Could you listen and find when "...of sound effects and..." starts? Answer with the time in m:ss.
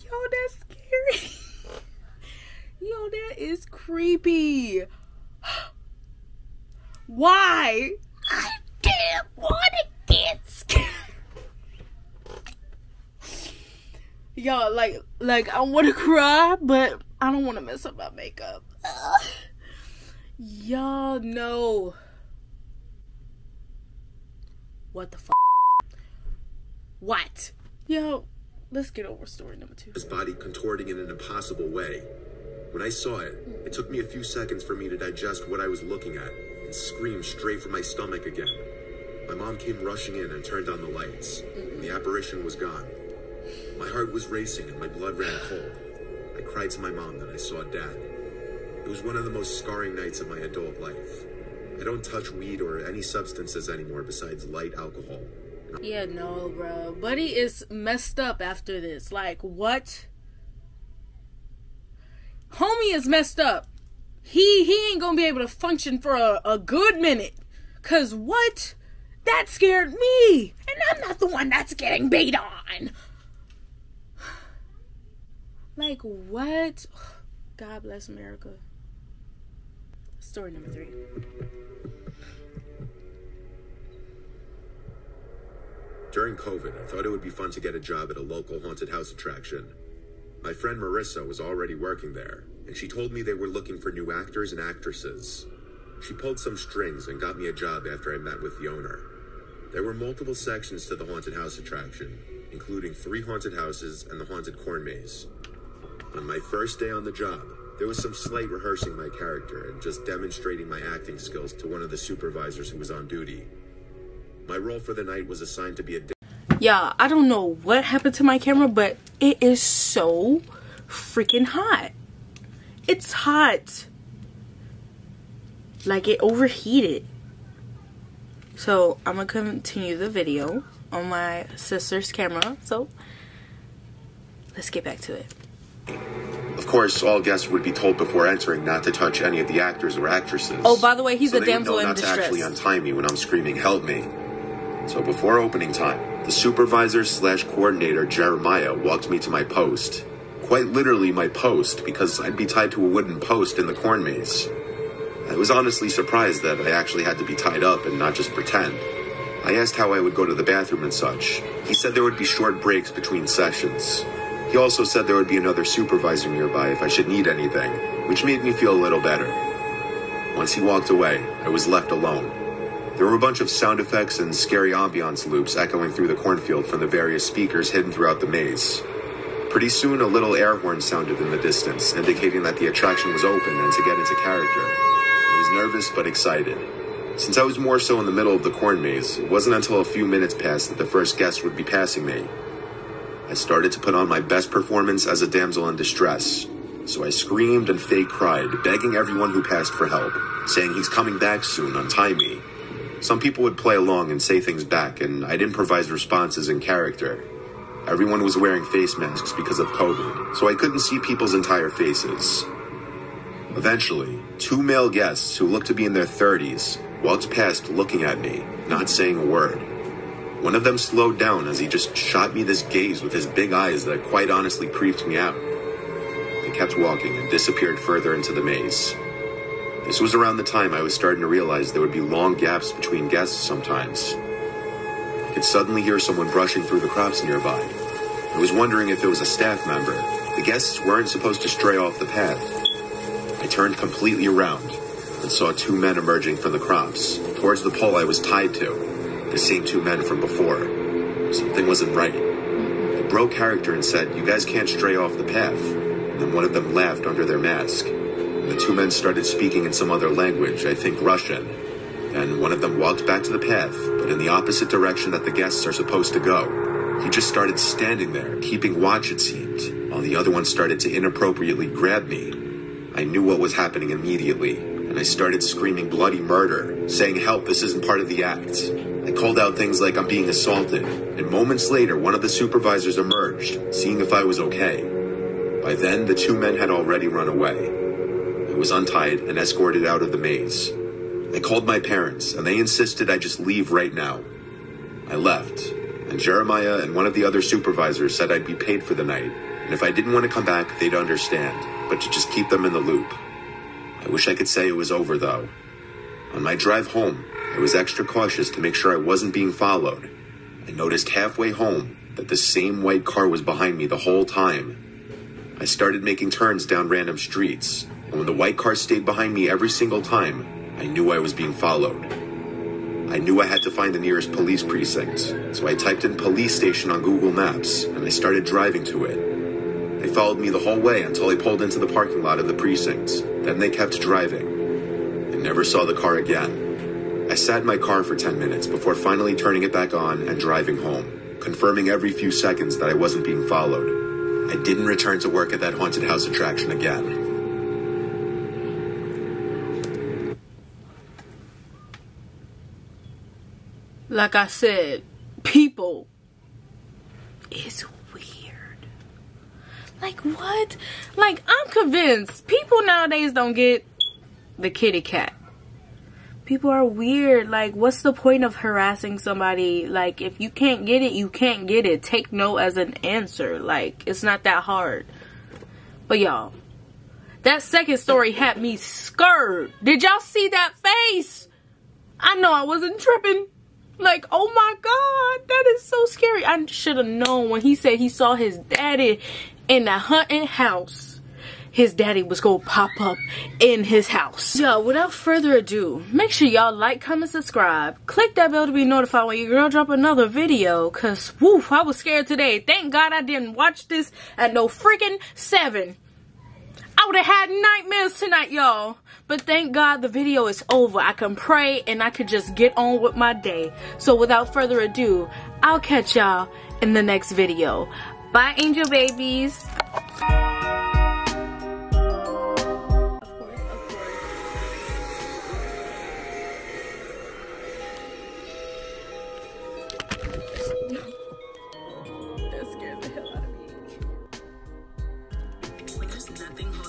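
2:53.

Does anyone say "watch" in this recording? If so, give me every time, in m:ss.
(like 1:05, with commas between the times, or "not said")
4:28, 6:43.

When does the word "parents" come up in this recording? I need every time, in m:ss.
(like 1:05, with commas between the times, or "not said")
4:51.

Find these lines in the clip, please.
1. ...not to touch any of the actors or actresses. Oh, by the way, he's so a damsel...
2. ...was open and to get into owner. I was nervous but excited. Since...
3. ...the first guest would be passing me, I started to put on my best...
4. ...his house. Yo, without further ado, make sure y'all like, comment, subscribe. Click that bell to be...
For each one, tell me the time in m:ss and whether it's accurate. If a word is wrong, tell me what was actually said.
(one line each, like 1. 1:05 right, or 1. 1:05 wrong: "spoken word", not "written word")
1. 2:18 right
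2. 3:03 wrong: "character", not "owner"
3. 3:10 right
4. 6:33 right.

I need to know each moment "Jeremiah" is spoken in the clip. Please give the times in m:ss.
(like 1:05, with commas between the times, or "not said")
2:28, 4:56.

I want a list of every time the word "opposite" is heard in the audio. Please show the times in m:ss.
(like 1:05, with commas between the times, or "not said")
4:24.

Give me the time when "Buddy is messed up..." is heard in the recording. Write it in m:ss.
0:57.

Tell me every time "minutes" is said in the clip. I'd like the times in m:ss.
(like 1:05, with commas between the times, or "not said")
1:06, 3:10, 5:38.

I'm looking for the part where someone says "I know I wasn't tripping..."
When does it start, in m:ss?
6:22.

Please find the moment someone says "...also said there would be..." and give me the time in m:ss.
2:44.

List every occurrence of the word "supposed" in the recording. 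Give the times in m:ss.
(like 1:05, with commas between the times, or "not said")
4:01, 4:25.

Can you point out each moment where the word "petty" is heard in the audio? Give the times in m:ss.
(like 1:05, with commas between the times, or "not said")
not said.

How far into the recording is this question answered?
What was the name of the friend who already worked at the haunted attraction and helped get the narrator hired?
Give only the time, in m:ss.
1:30.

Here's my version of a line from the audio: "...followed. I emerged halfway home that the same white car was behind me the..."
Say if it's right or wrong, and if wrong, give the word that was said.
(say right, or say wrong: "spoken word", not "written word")
wrong: "noticed", not "emerged".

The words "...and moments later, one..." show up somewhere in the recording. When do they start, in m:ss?
4:40.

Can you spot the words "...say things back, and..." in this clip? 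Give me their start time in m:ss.
3:24.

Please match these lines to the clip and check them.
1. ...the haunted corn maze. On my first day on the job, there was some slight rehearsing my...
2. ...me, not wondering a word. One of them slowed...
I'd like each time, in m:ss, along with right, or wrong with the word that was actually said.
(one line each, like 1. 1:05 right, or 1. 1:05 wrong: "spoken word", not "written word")
1. 1:44 right
2. 3:38 wrong: "saying", not "wondering".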